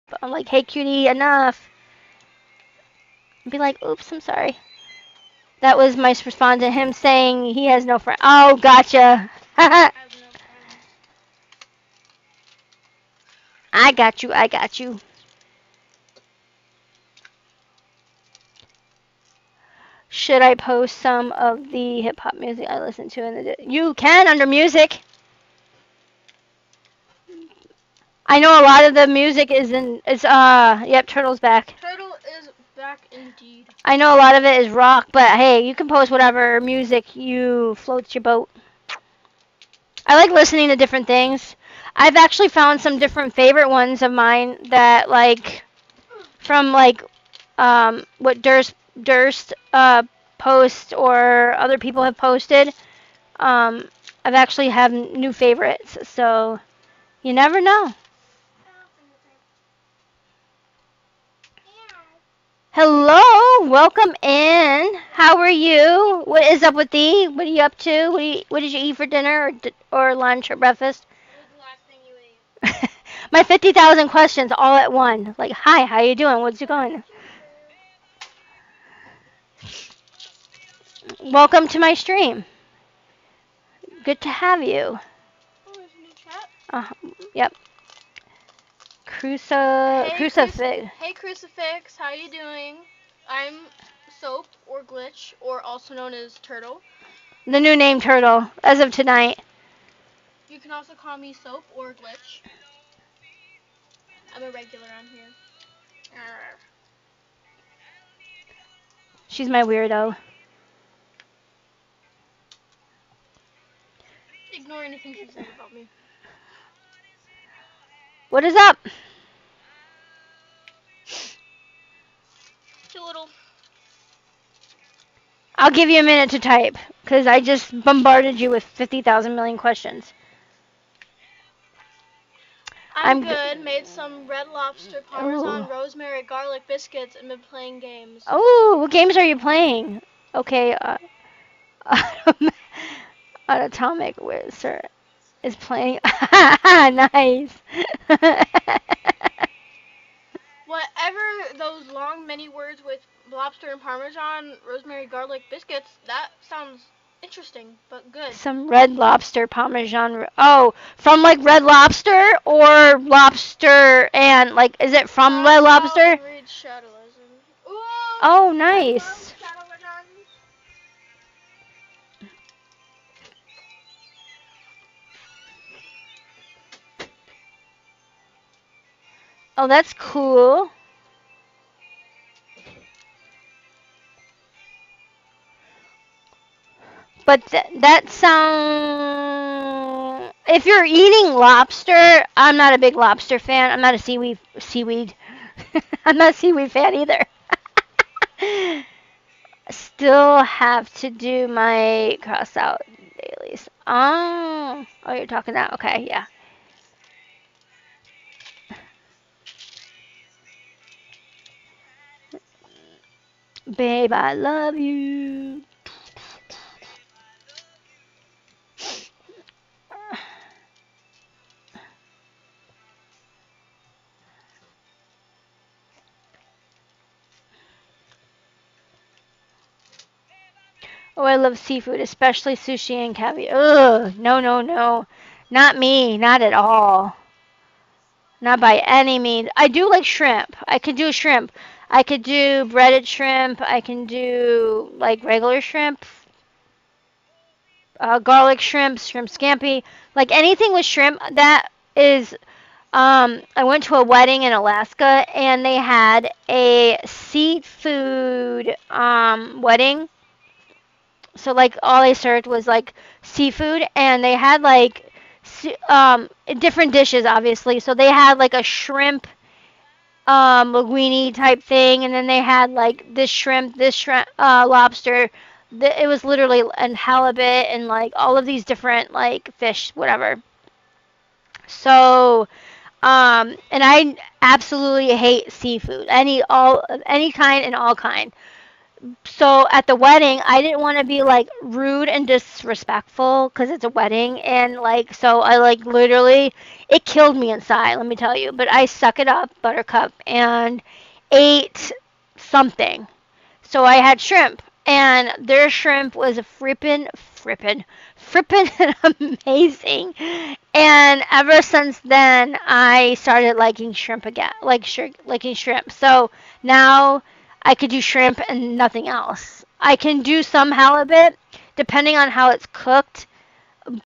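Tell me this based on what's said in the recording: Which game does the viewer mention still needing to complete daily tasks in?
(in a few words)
Crossout.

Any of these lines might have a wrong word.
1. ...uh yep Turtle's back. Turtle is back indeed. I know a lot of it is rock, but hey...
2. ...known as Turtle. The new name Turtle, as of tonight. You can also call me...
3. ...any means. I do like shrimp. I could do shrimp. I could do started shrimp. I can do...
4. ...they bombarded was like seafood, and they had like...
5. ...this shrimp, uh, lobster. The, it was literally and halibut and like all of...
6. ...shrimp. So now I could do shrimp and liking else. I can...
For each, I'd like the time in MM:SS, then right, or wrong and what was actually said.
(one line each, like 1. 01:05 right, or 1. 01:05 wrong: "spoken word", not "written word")
1. 00:30 right
2. 01:35 right
3. 03:58 wrong: "breaded", not "started"
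4. 04:22 wrong: "served", not "bombarded"
5. 04:33 right
6. 05:15 wrong: "nothing", not "liking".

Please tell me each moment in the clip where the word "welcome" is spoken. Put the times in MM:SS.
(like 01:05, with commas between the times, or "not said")
01:03, 01:21.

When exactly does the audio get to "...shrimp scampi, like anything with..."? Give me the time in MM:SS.
04:08.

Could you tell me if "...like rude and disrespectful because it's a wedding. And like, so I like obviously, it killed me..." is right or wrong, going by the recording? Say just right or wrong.
wrong.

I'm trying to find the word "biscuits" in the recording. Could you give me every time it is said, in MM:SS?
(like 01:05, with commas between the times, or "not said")
02:16, 02:35.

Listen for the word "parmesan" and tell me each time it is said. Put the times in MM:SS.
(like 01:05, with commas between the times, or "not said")
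02:15, 02:33, 02:39.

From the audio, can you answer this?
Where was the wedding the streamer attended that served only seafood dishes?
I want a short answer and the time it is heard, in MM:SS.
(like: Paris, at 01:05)
Alaska, at 04:14.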